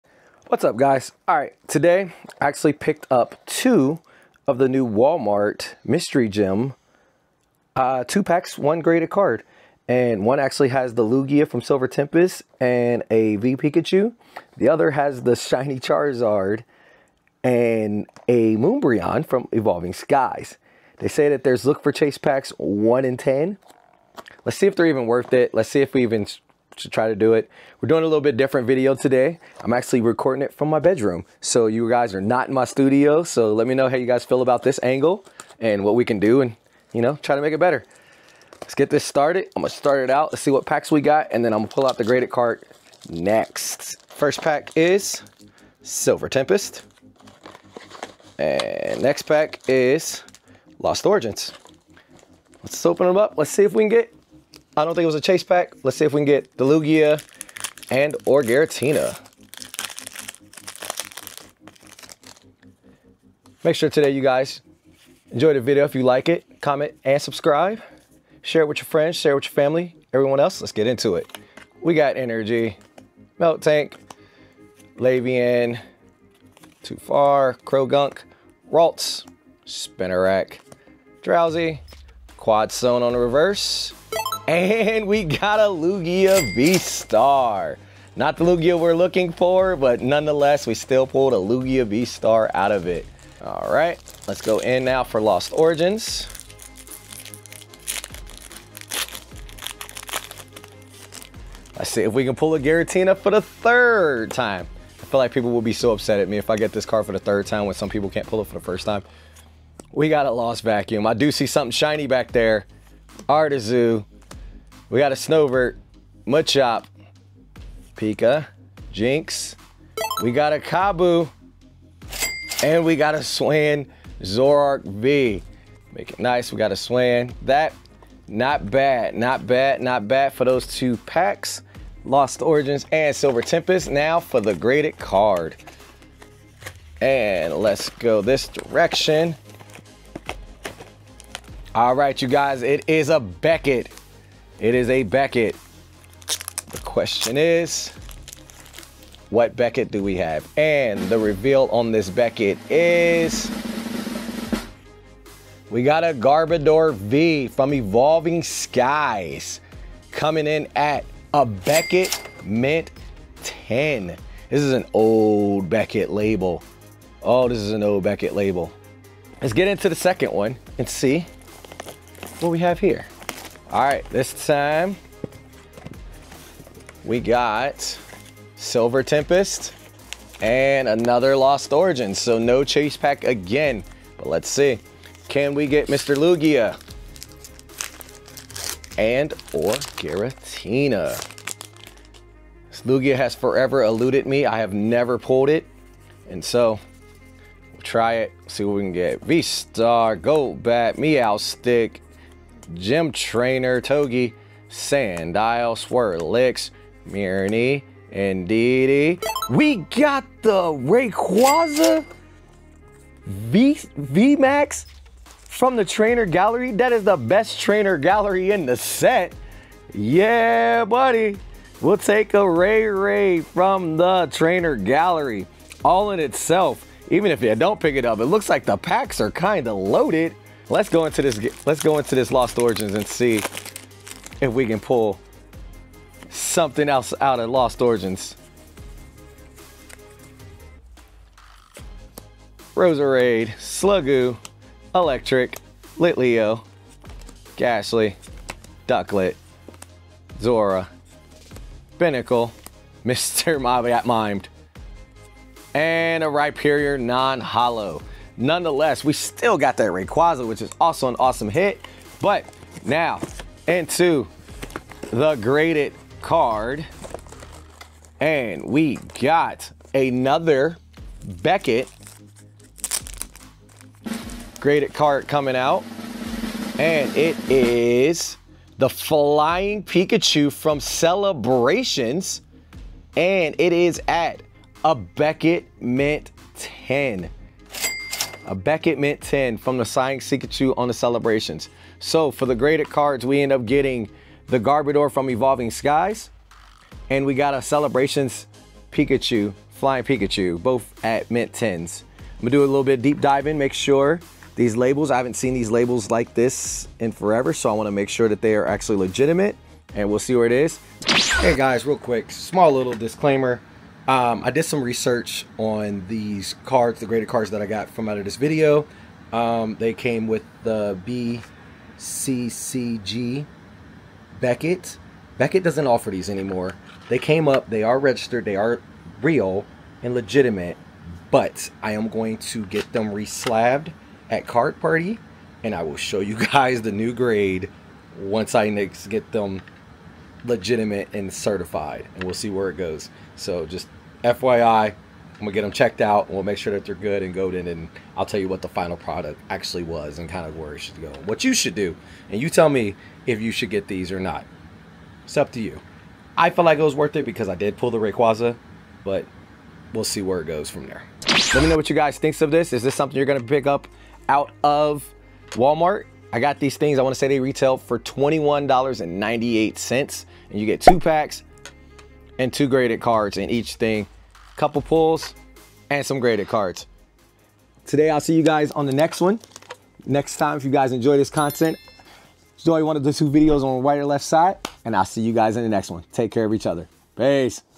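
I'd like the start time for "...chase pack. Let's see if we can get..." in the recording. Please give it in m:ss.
0:55.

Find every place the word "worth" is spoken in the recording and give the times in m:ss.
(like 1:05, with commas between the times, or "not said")
0:25, 5:56.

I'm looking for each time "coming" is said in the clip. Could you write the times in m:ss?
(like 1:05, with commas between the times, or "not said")
2:40, 4:35.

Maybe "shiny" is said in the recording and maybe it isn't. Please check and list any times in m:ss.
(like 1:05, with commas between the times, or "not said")
0:15, 1:51.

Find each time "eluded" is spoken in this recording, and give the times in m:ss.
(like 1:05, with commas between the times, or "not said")
3:13.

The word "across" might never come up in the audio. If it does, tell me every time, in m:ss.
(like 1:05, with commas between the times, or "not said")
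not said.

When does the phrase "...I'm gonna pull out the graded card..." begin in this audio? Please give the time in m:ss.
0:41.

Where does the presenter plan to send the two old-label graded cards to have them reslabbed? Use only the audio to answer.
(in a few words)
Card Party.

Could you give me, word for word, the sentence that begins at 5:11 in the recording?
Hey guys, real quick, small little disclaimer.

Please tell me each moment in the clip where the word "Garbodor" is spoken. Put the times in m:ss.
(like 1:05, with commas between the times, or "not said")
2:36, 4:54.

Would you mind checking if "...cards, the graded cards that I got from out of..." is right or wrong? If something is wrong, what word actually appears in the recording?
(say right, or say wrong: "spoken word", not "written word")
right.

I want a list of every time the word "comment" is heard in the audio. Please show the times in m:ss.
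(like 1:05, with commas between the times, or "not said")
1:06.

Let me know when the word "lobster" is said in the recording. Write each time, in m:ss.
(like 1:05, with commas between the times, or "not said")
not said.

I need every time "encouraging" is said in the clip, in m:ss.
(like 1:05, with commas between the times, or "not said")
not said.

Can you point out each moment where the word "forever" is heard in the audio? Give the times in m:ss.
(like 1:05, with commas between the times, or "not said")
3:13, 5:07.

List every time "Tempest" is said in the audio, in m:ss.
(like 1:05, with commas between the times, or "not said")
0:11, 0:46, 2:13, 2:59.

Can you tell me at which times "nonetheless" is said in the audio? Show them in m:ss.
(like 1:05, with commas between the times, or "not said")
1:30, 4:18.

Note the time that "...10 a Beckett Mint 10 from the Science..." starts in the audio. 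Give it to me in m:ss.
4:46.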